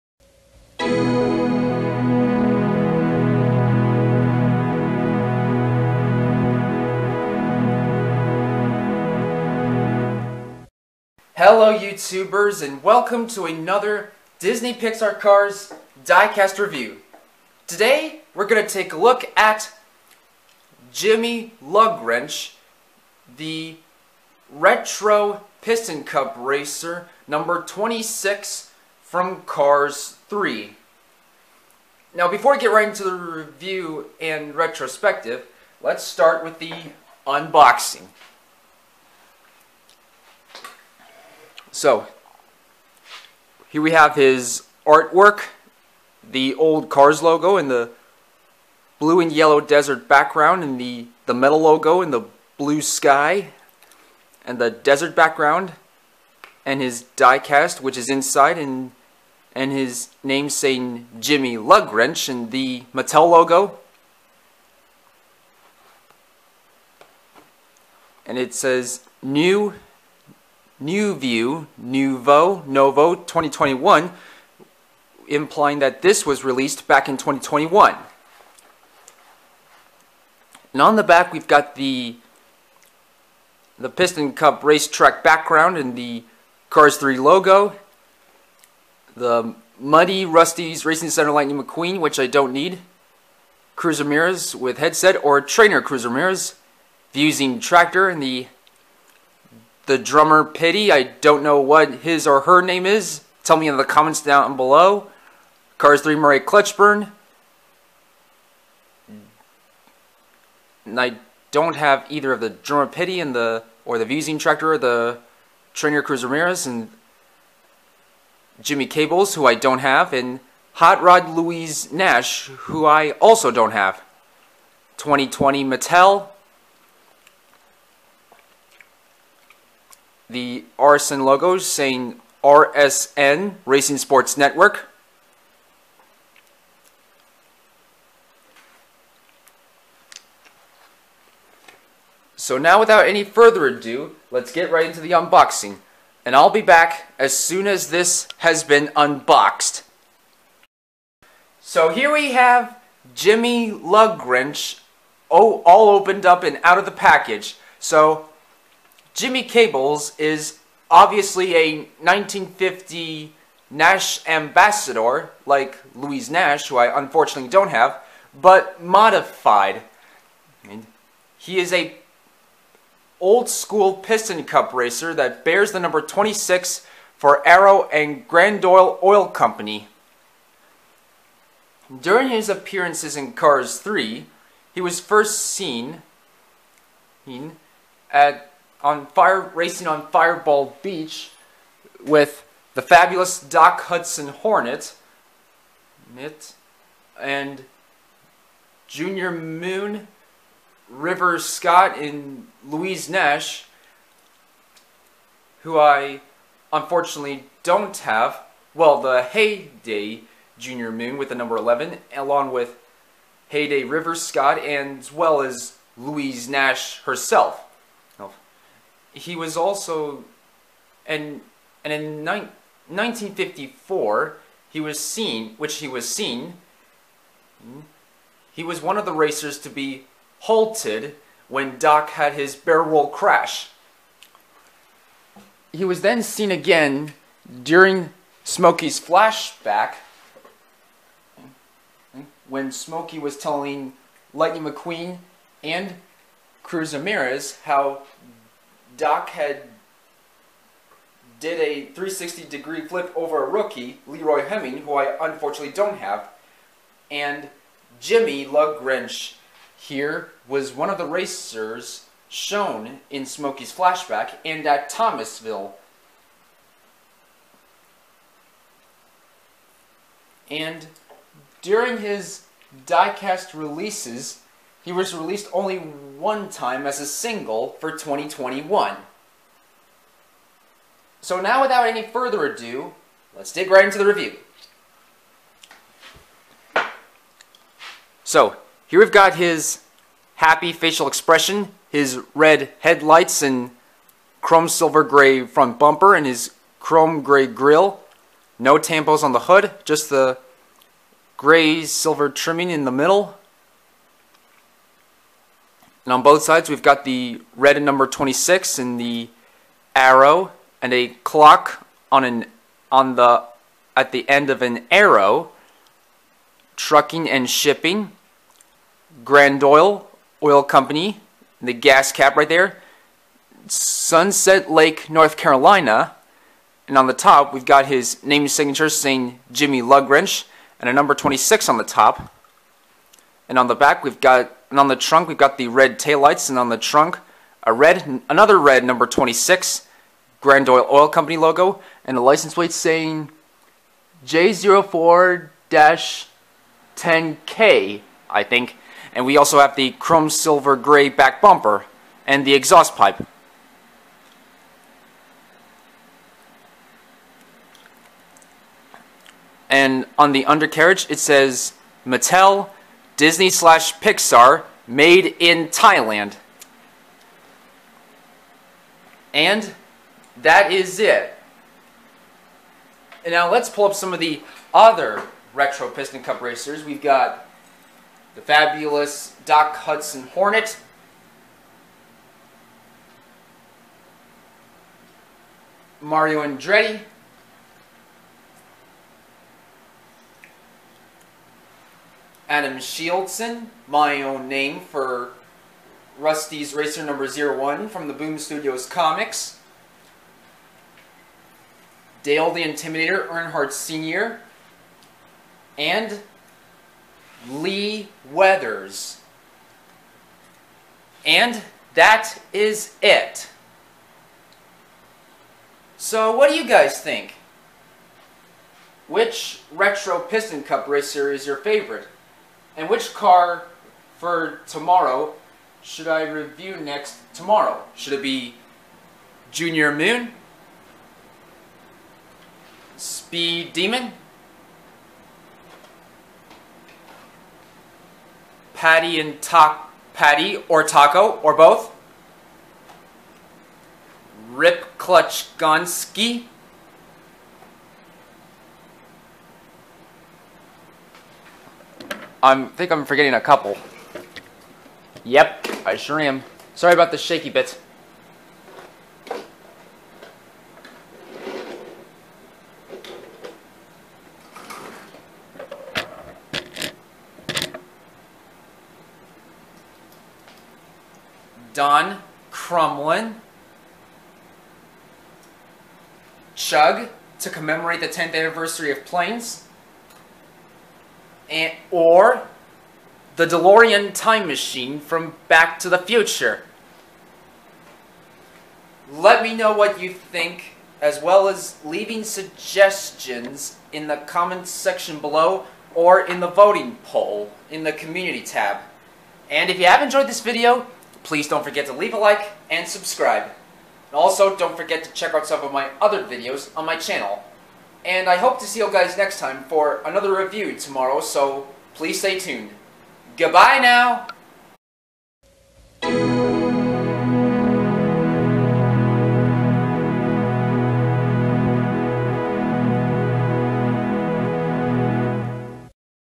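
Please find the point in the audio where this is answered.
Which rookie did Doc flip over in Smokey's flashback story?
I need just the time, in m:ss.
4:14.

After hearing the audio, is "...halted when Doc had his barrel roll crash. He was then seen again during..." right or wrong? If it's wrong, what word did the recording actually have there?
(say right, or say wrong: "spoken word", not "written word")
right.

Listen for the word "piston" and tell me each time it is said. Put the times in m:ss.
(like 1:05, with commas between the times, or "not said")
0:25, 1:23, 2:53, 6:15, 7:00.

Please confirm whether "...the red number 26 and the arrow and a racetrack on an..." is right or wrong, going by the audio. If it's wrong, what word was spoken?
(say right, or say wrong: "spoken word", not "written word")
wrong: "clock", not "racetrack".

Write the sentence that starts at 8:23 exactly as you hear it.
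And also, don't forget to check out some of my other videos on my channel.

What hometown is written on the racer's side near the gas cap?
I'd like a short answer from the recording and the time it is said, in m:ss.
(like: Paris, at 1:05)
Sunset Lake, North Carolina, at 5:23.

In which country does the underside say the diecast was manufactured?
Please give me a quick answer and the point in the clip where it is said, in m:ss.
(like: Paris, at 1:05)
Thailand, at 6:05.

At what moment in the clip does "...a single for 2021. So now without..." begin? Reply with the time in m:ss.
4:36.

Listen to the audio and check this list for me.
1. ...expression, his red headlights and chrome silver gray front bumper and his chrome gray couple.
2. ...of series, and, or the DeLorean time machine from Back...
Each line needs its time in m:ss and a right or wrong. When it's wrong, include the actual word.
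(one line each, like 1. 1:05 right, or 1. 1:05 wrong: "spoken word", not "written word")
1. 4:51 wrong: "grille", not "couple"
2. 7:58 wrong: "planes", not "series".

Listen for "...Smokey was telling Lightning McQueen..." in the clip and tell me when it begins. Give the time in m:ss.
4:02.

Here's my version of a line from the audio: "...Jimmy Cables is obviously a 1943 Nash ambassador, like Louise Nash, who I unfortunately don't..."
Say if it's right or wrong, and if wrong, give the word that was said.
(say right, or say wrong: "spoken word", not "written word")
wrong: "1950", not "1943".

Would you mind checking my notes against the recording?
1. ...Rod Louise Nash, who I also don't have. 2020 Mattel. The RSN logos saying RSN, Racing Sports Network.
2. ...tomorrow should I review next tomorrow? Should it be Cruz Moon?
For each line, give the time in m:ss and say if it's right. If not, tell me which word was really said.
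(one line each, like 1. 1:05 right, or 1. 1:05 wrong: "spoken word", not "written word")
1. 2:01 right
2. 7:04 wrong: "Junior", not "Cruz".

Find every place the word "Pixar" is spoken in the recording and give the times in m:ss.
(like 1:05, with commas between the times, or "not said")
0:14, 6:03.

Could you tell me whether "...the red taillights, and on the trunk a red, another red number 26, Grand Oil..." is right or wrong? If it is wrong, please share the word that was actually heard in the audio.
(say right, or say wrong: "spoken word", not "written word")
right.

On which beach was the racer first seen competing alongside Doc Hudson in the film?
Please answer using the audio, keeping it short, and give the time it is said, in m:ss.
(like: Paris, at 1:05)
Fireball Beach, at 3:10.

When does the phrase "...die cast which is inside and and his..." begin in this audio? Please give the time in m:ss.
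0:57.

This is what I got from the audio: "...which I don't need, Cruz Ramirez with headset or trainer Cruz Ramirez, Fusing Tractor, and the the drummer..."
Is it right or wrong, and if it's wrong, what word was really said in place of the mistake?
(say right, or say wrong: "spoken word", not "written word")
right.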